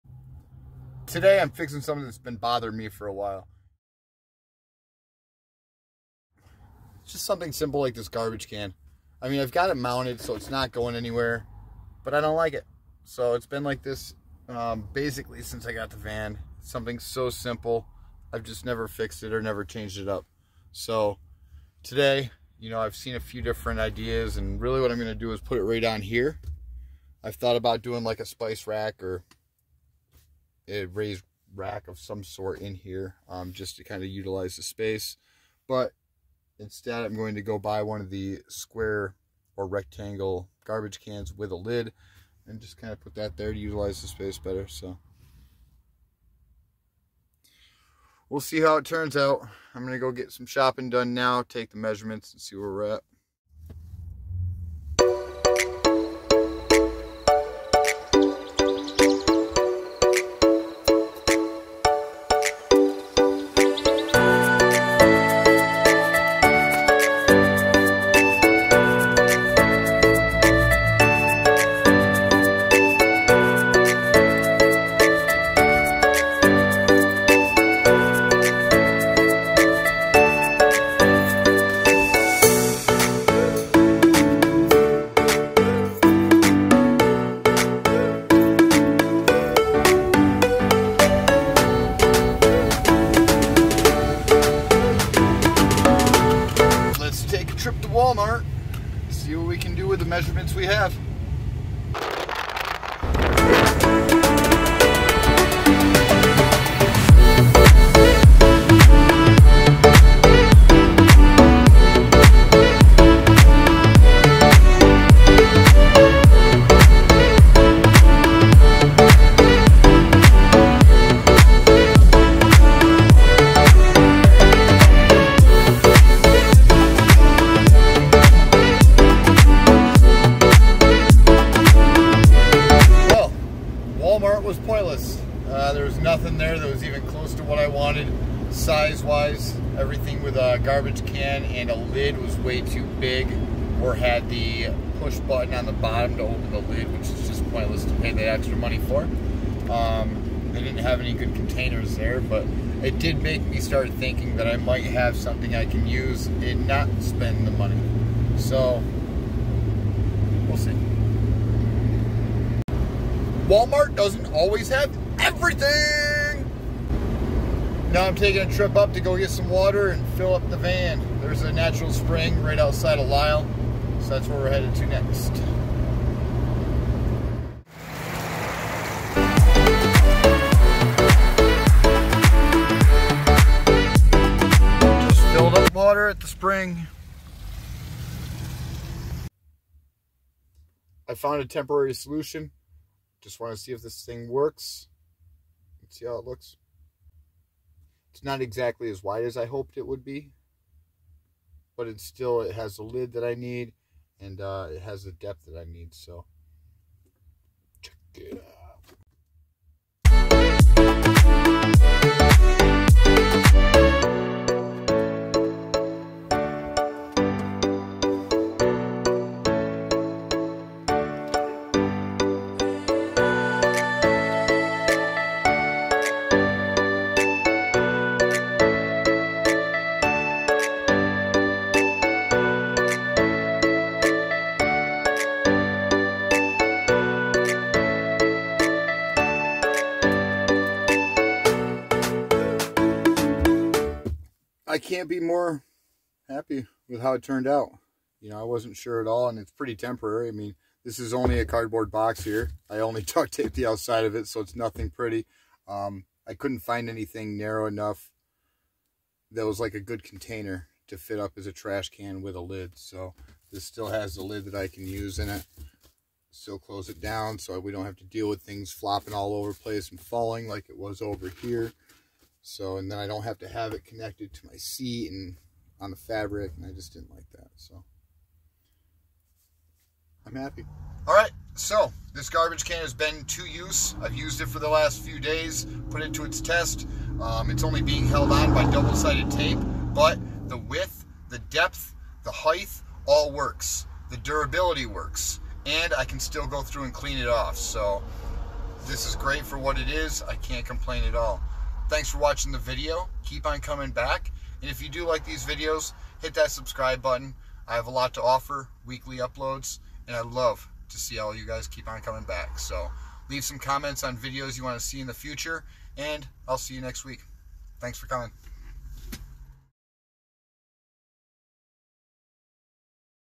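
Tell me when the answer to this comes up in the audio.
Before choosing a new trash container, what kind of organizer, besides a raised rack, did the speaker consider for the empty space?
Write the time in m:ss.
0:28.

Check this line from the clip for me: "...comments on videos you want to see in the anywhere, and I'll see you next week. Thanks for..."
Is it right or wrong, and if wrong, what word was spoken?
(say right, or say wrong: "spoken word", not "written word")
wrong: "future", not "anywhere".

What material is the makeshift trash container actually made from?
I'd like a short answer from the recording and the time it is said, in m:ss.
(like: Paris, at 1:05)
Cardboard, at 4:11.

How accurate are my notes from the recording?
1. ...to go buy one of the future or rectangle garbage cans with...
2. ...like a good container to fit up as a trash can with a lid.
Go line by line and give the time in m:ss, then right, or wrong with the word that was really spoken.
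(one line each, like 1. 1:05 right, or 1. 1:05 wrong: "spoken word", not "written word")
1. 0:37 wrong: "square", not "future"
2. 4:19 right.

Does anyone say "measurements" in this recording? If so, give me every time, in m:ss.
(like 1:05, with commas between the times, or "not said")
0:51, 1:40.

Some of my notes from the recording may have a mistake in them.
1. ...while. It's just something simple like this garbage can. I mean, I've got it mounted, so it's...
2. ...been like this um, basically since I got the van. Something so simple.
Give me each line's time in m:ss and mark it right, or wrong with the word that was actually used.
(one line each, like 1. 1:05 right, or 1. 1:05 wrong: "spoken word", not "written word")
1. 0:03 right
2. 0:13 right.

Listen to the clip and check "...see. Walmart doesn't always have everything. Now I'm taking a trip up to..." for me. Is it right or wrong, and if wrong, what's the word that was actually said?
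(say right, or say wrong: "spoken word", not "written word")
right.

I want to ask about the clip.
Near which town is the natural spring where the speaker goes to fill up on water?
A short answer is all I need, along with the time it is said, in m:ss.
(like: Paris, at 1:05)
Lyle, at 2:53.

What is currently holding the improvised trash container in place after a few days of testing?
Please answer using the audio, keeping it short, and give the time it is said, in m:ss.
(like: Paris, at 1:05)
Double-sided tape, at 4:48.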